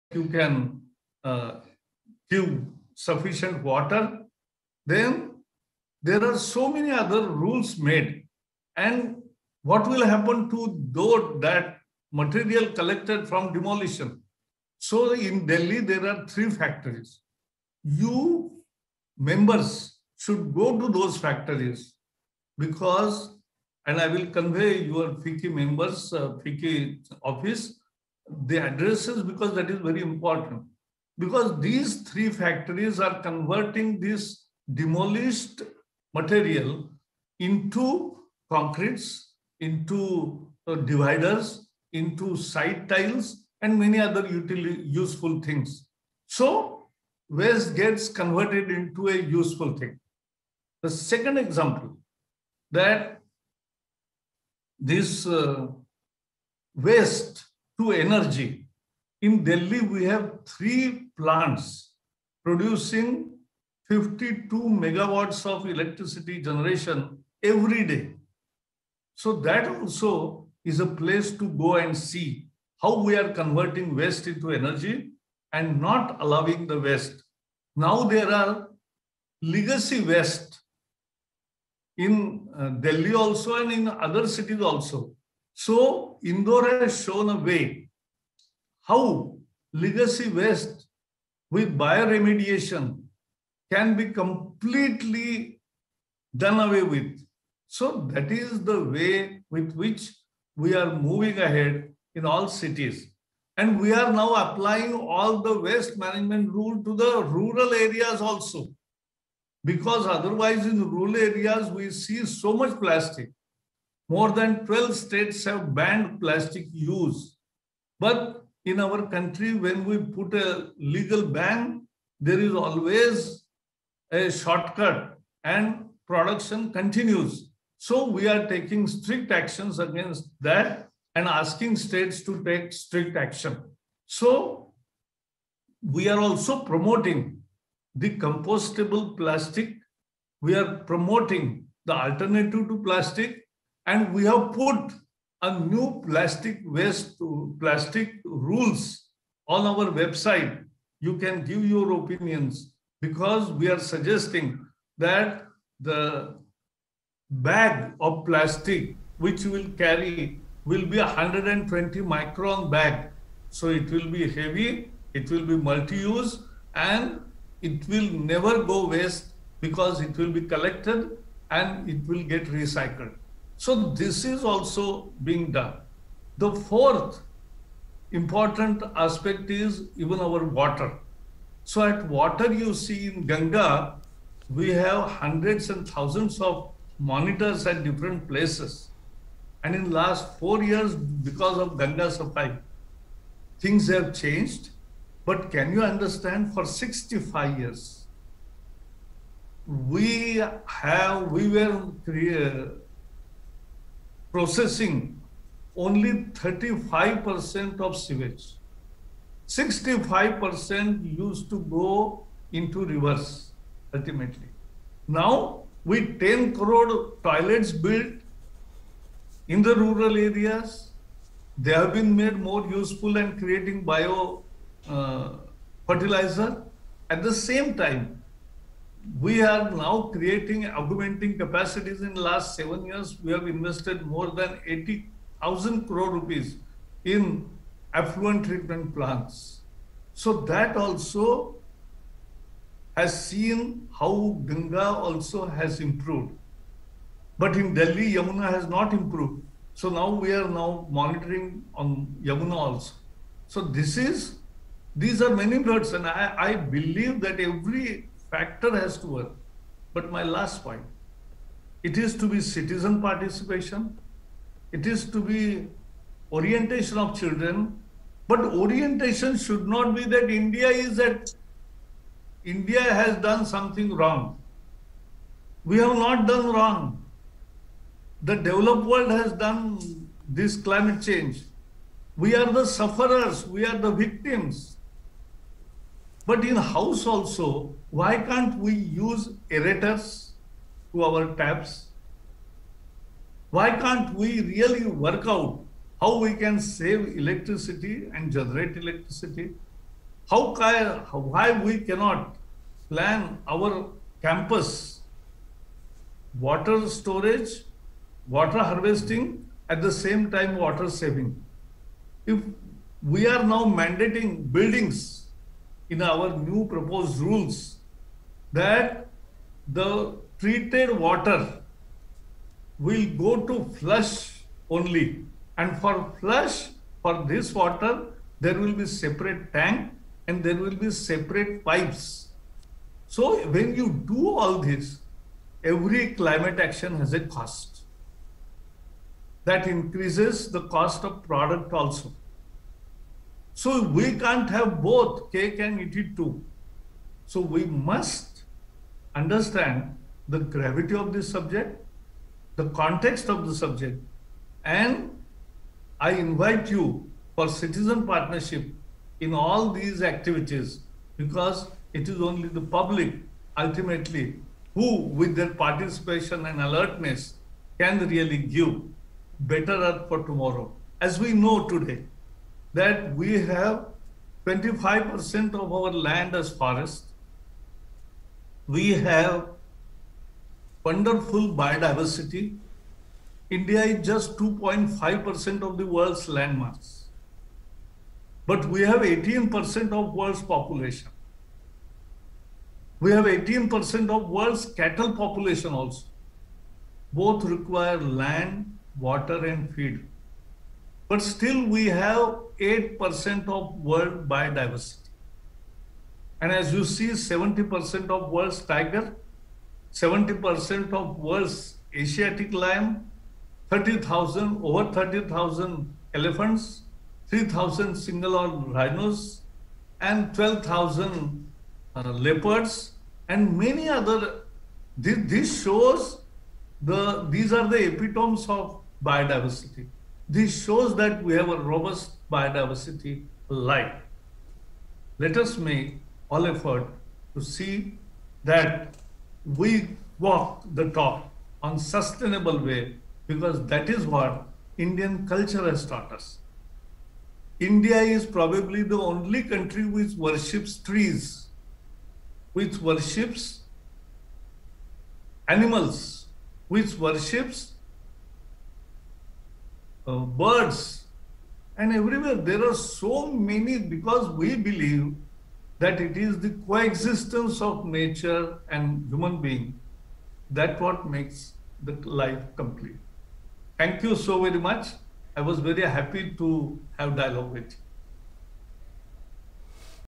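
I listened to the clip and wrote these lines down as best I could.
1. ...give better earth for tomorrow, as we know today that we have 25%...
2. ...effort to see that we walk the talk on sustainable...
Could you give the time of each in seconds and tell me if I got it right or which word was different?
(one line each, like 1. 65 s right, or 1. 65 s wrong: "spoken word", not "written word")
1. 368 s right
2. 436 s right.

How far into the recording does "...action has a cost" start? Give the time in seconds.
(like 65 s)
336 s.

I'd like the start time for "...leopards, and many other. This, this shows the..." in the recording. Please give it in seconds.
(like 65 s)
422 s.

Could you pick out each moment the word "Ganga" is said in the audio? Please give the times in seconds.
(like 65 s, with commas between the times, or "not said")
183 s, 191 s, 244 s.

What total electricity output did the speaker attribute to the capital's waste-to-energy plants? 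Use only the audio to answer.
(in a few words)
52 megawatts.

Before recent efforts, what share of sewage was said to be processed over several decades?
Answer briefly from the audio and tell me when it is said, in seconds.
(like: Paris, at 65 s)
35%, at 206 s.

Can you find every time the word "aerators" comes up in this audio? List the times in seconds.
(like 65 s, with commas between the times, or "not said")
289 s.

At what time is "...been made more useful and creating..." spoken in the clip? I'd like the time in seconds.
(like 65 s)
221 s.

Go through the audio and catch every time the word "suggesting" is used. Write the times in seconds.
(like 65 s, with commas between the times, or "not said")
153 s.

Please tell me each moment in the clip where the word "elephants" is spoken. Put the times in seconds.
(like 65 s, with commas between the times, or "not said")
416 s.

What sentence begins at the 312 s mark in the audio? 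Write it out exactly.
If we are now mandating buildings in our new proposed rules that the treated water will go to flush only.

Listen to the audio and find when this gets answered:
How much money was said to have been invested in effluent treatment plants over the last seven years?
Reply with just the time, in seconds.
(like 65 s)
234 s.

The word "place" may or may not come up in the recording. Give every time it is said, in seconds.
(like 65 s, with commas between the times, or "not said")
70 s, 188 s.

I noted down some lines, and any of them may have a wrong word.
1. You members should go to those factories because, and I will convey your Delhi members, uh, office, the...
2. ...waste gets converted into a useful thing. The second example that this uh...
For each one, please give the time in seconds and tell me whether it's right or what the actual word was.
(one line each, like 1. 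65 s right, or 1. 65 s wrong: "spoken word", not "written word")
1. 17 s wrong: "FICCI", not "Delhi"
2. 47 s right.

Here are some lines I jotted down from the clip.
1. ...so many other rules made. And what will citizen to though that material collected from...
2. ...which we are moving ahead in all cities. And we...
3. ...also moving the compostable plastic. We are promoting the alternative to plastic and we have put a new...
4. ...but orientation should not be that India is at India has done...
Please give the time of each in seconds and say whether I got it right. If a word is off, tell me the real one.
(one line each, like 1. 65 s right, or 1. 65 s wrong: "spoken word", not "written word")
1. 6 s wrong: "happen", not "citizen"
2. 99 s right
3. 136 s wrong: "promoting", not "moving"
4. 268 s right.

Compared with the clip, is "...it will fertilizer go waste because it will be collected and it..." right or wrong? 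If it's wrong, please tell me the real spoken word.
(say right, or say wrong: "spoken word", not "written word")
wrong: "never", not "fertilizer".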